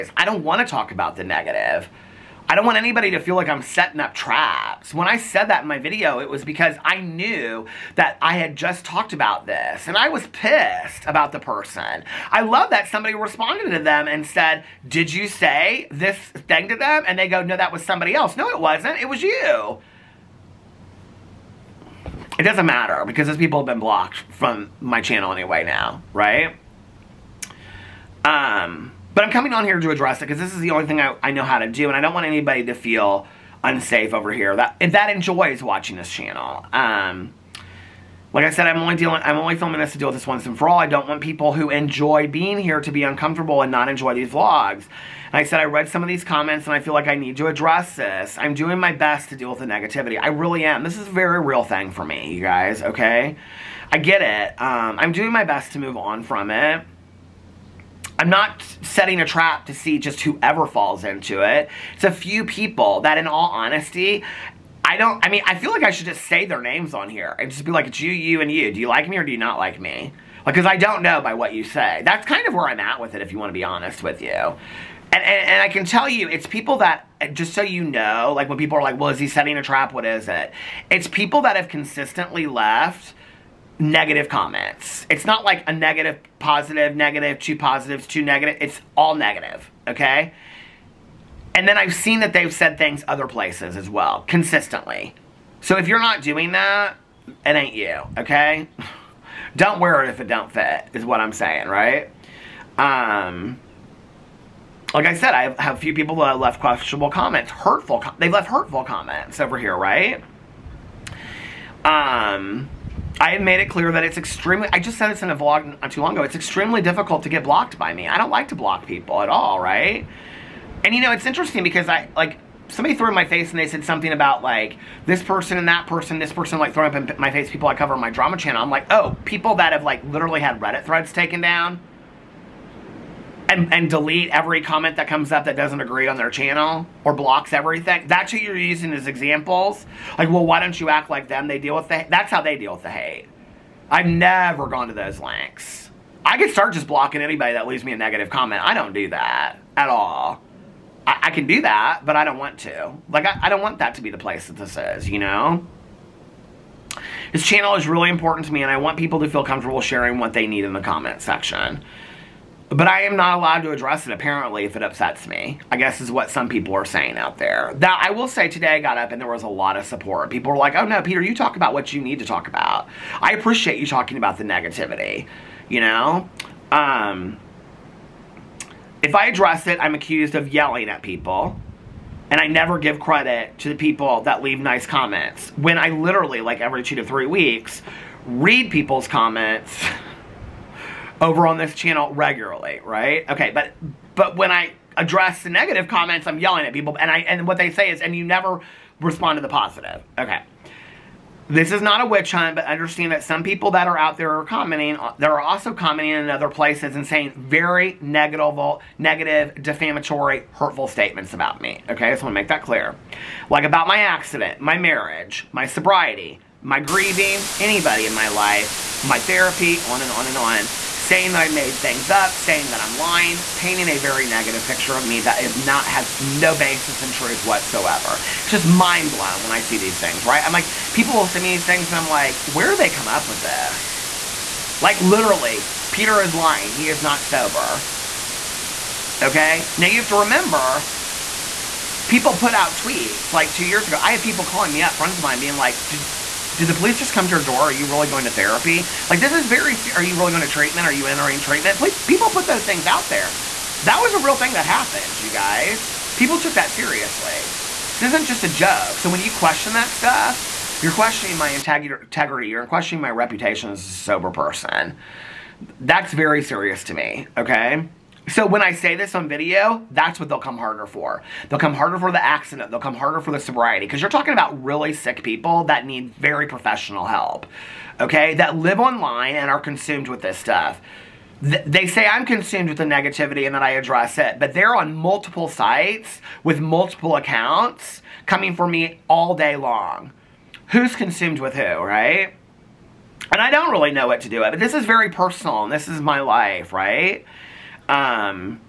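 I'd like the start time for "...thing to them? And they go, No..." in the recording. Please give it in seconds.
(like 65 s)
16 s.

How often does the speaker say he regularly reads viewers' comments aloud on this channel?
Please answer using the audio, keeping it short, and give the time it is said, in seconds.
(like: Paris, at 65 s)
Every 2 to 3 weeks, at 186 s.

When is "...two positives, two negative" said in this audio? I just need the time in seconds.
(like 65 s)
87 s.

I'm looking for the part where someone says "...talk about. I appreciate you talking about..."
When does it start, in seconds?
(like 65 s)
172 s.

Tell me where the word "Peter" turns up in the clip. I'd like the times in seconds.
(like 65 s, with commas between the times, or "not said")
171 s, 235 s.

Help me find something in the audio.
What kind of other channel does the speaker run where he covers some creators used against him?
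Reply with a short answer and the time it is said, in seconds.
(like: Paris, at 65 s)
Drama channel, at 128 s.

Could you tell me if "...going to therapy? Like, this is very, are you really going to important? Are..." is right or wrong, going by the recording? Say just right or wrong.
wrong.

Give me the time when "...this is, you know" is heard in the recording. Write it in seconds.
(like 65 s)
154 s.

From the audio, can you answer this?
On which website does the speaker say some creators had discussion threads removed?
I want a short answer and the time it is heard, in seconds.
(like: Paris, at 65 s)
Reddit, at 130 s.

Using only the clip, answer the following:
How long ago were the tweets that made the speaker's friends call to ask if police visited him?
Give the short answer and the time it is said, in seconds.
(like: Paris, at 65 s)
2 years ago, at 243 s.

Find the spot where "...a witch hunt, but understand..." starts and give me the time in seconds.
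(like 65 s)
202 s.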